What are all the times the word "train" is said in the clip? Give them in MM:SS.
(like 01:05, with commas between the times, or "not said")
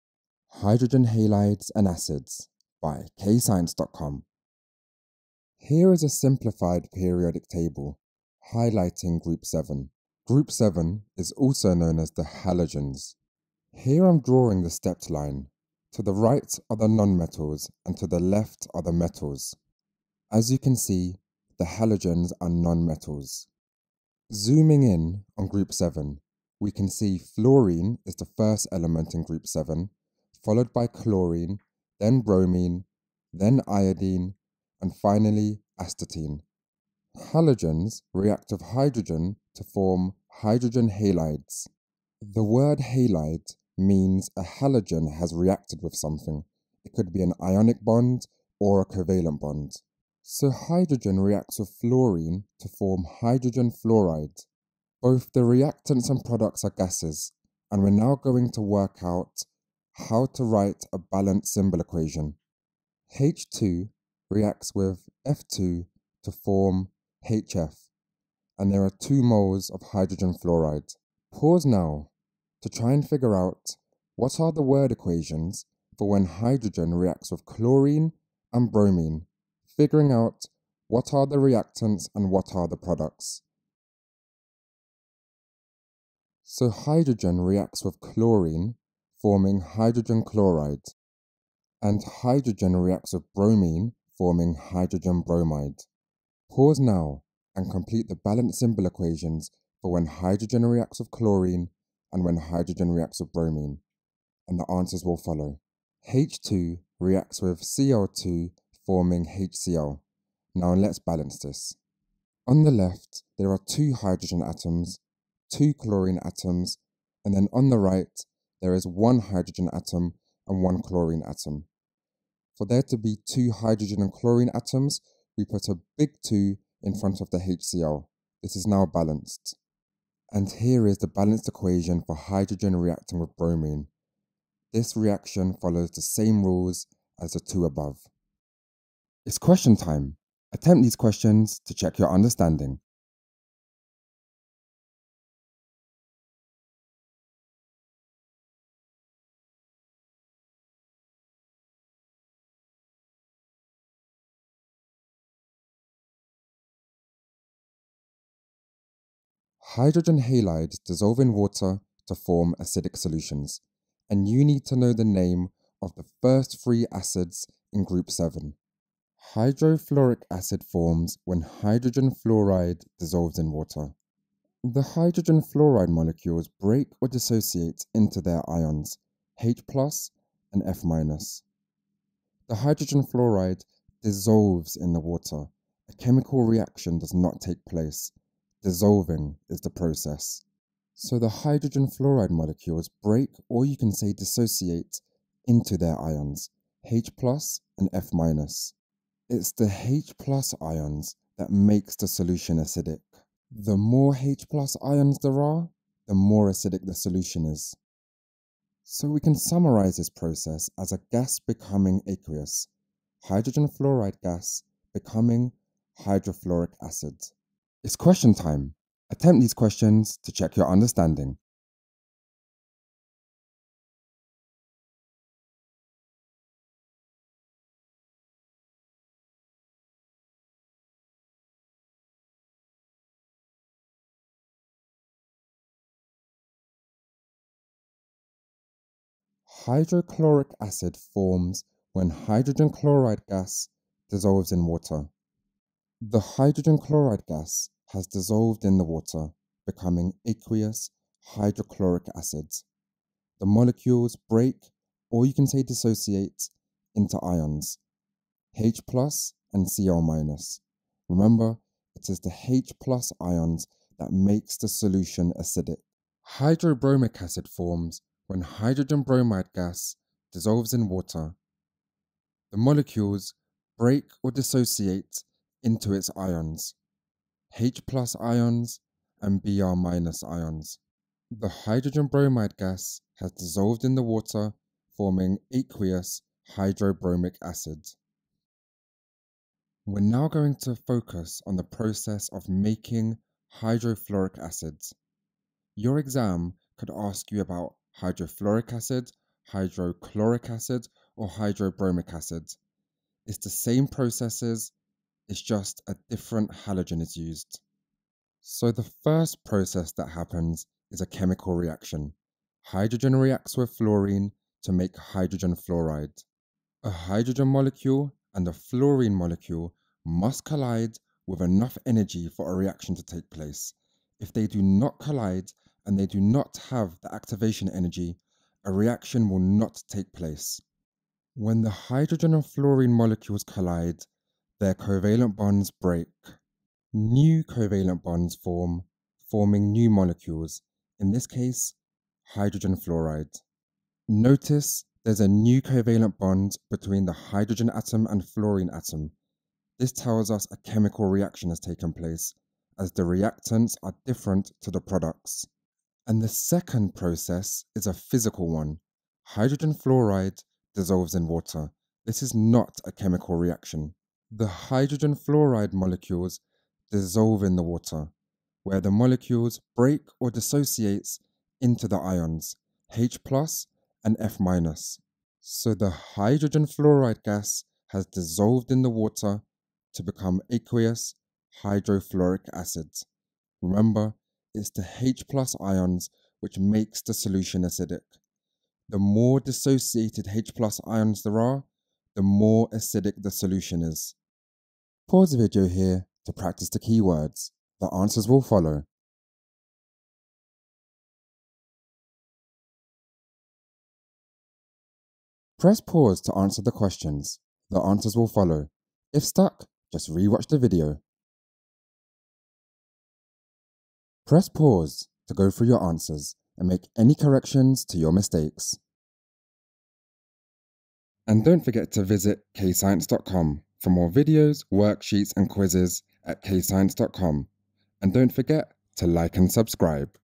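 not said.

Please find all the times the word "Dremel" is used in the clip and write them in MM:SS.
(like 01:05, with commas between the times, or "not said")
not said.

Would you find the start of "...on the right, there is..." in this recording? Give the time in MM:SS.
01:57.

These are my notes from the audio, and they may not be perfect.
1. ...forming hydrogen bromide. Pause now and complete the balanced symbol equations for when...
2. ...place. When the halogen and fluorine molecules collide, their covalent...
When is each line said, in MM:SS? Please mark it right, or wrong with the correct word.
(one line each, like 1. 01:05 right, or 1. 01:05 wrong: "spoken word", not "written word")
1. 01:34 right
2. 05:30 wrong: "hydrogen", not "halogen".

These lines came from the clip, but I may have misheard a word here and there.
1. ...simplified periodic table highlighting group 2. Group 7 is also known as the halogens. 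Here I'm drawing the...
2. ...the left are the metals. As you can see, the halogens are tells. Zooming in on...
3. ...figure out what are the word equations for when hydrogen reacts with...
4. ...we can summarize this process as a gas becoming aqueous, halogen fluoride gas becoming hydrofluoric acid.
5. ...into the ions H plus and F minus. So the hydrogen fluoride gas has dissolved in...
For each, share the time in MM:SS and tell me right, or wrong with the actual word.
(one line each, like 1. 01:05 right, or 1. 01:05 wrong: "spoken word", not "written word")
1. 00:06 wrong: "7", not "2"
2. 00:18 wrong: "nonmetals", not "tells"
3. 01:13 right
4. 03:29 wrong: "hydrogen", not "halogen"
5. 06:11 right.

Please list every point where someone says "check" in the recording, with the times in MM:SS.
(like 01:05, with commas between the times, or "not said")
02:21, 03:40.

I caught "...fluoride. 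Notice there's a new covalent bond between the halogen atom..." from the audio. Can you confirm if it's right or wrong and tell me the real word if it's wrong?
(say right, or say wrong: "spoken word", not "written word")
wrong: "hydrogen", not "halogen".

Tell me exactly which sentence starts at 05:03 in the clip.
It's the same processes it's just a different halogen is used.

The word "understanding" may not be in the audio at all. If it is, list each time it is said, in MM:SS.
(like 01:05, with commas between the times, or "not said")
02:22, 03:40.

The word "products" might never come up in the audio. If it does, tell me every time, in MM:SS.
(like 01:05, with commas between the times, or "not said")
00:56, 01:22, 05:54.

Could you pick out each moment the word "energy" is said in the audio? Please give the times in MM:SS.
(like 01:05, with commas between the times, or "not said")
05:21, 05:27.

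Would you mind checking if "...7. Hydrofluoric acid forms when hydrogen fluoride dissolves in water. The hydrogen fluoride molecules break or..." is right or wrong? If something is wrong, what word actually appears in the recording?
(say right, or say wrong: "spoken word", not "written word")
right.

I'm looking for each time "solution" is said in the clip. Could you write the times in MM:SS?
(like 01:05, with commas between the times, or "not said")
02:42, 03:22, 03:26, 04:24, 06:27, 06:33.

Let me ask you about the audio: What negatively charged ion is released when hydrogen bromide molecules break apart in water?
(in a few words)
Br minus.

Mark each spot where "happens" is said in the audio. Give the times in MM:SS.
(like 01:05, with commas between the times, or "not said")
05:10.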